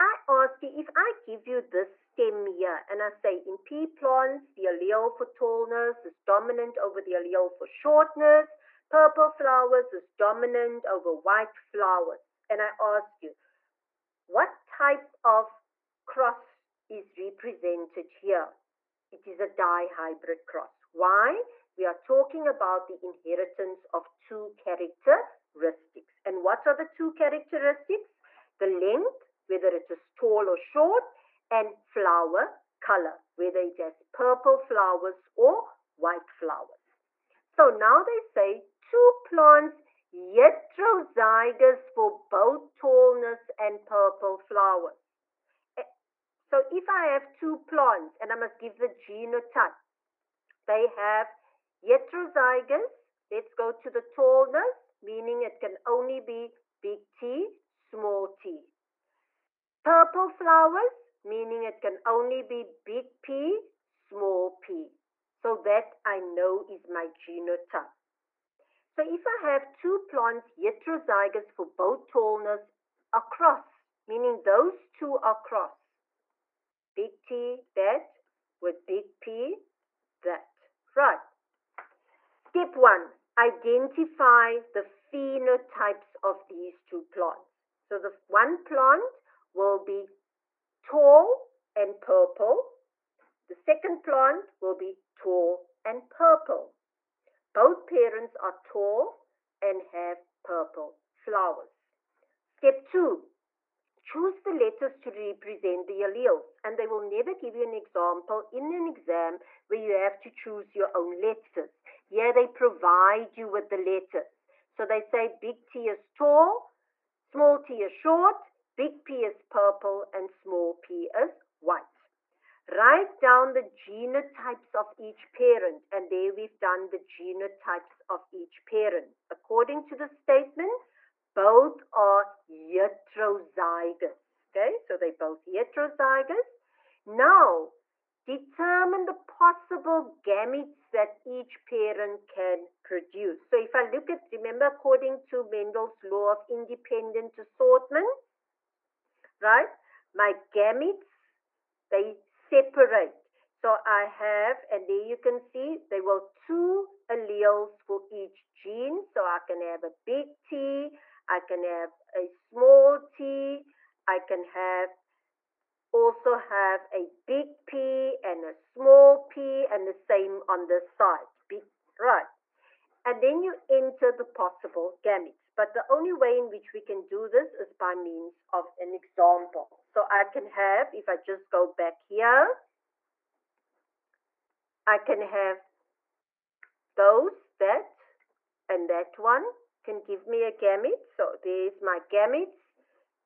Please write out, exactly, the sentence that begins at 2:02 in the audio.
Write down the genotypes of each parent, and there we've done the genotypes of each parent.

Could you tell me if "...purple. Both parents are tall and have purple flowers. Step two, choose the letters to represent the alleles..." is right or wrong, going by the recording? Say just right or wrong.
right.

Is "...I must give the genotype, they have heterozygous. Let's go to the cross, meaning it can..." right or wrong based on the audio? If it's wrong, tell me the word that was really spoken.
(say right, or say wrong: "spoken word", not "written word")
wrong: "tallness", not "cross".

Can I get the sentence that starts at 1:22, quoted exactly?
Step one, identify the phenotypes of these two plants.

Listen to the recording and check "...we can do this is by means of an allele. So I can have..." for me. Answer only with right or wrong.
wrong.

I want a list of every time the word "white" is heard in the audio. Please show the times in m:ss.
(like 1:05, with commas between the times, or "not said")
0:11, 0:35, 2:01.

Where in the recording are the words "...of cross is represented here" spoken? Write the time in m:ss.
0:15.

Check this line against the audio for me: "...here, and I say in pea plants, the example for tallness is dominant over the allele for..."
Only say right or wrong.
wrong.